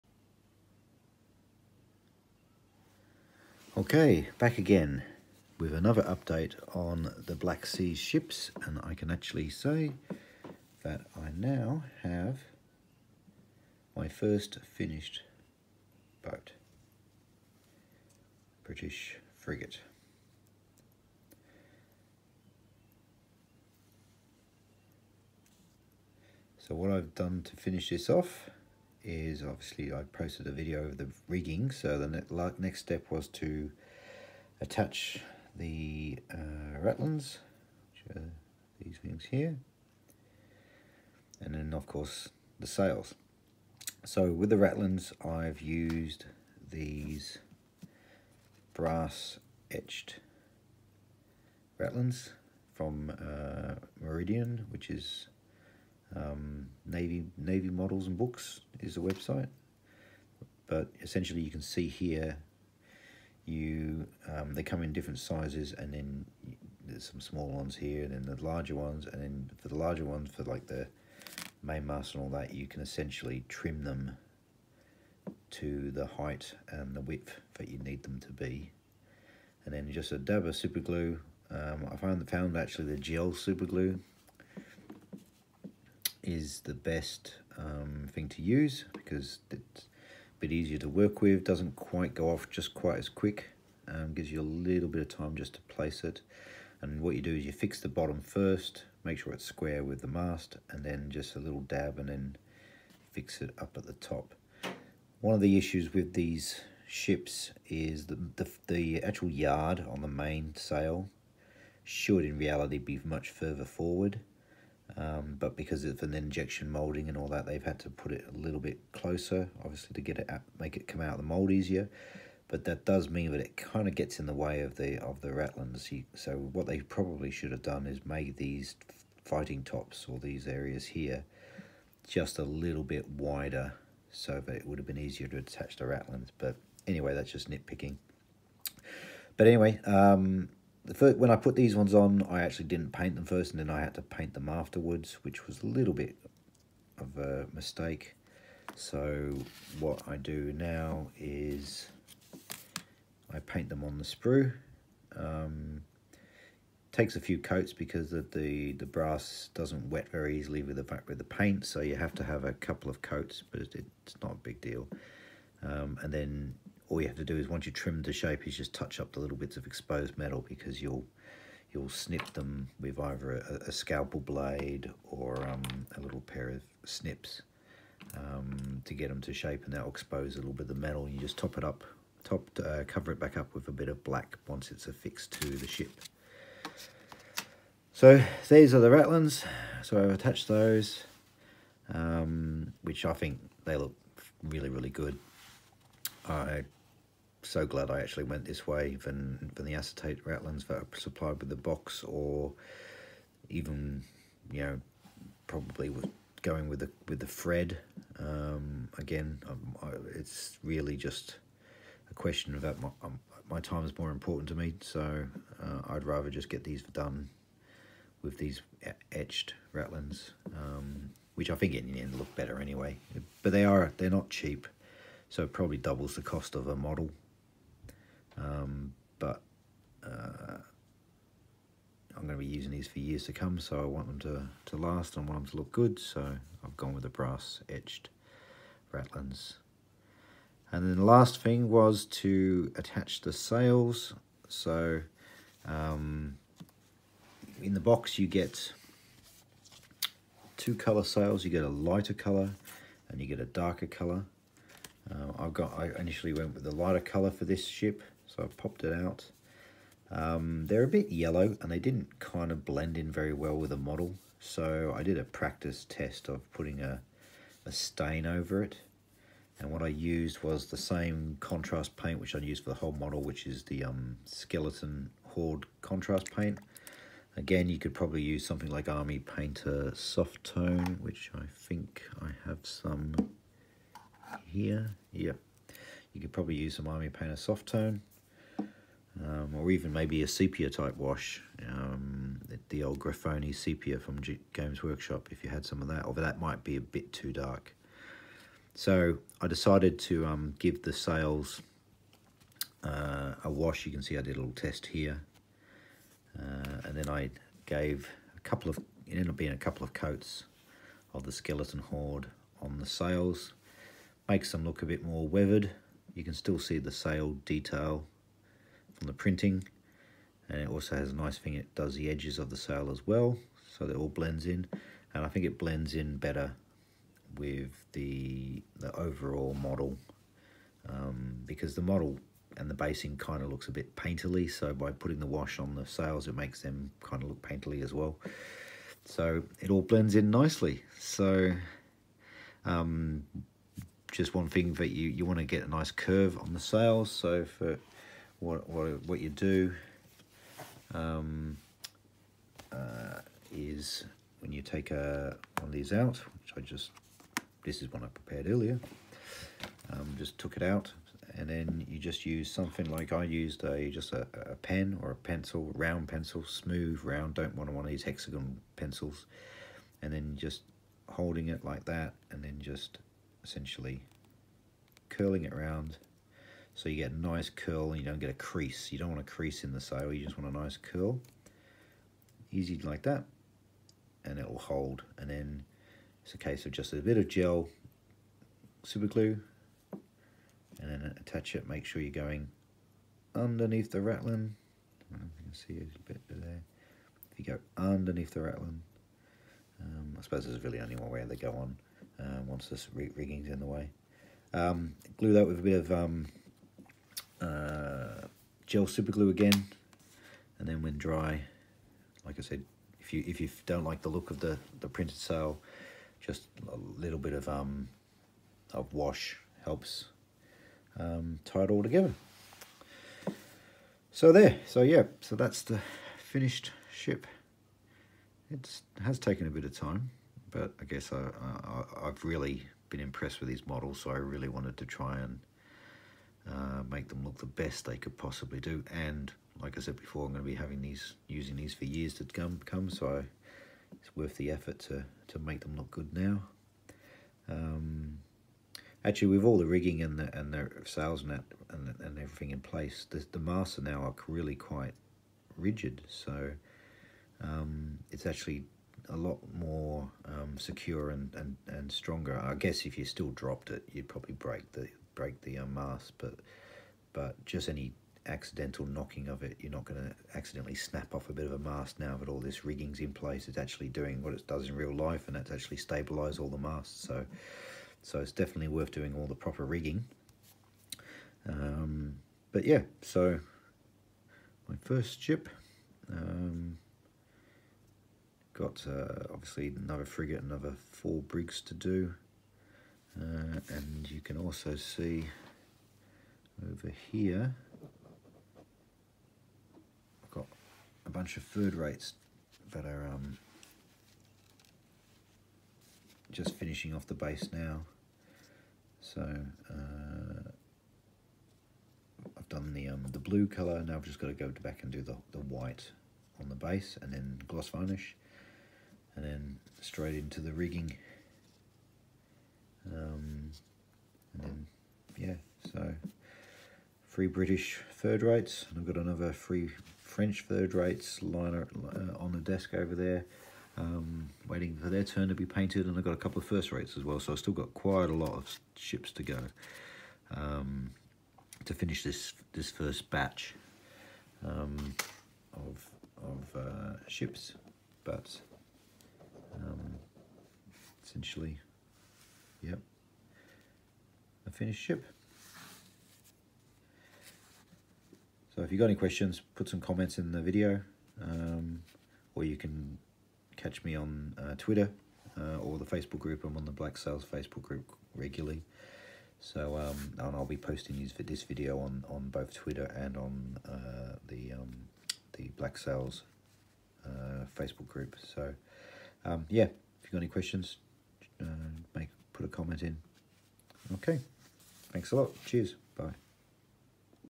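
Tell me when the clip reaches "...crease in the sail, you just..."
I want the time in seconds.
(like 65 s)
379 s.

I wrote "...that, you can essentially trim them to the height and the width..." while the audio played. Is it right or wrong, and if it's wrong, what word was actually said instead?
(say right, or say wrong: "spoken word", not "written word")
right.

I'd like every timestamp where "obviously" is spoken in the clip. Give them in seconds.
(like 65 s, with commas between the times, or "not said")
29 s, 119 s, 489 s.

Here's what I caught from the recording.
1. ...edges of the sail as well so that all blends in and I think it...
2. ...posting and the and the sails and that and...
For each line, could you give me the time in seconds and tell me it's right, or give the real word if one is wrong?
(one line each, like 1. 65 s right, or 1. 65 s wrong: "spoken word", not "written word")
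1. 322 s right
2. 449 s wrong: "rigging", not "posting".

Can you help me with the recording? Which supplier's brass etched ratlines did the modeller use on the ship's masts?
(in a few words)
Meridian.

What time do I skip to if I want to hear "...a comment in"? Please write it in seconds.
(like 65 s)
582 s.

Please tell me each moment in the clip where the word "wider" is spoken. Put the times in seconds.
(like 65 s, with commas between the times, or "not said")
133 s.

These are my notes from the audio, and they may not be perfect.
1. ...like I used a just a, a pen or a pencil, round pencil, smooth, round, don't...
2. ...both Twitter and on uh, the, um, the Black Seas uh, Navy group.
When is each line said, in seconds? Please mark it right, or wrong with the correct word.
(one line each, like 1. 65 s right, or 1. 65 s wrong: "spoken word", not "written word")
1. 362 s right
2. 572 s wrong: "Facebook", not "Navy".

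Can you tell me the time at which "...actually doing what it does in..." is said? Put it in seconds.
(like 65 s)
473 s.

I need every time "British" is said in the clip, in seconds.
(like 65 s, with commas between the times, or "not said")
18 s, 527 s.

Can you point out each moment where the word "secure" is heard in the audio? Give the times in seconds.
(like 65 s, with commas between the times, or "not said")
460 s.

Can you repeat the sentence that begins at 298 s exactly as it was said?
So I decided to um, give the sails uh, a wash.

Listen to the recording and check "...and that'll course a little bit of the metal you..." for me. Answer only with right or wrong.
wrong.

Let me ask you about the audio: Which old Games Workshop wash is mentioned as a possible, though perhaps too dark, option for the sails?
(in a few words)
Gryphonne Sepia.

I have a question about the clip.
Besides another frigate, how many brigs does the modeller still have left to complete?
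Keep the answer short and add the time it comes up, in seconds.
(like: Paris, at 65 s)
4, at 490 s.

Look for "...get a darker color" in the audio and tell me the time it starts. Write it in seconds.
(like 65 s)
253 s.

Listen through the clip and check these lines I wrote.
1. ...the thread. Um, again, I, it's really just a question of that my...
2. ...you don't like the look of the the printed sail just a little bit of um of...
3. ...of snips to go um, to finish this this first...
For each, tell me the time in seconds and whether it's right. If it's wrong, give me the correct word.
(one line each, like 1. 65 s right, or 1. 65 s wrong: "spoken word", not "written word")
1. 207 s right
2. 413 s right
3. 538 s wrong: "ships", not "snips".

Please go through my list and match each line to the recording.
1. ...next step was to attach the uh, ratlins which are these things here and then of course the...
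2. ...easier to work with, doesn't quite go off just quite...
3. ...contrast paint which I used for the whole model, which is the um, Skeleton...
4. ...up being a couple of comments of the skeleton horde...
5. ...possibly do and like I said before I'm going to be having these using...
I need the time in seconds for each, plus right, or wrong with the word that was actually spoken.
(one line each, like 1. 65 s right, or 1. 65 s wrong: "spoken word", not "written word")
1. 32 s right
2. 90 s right
3. 271 s right
4. 309 s wrong: "coats", not "comments"
5. 438 s right.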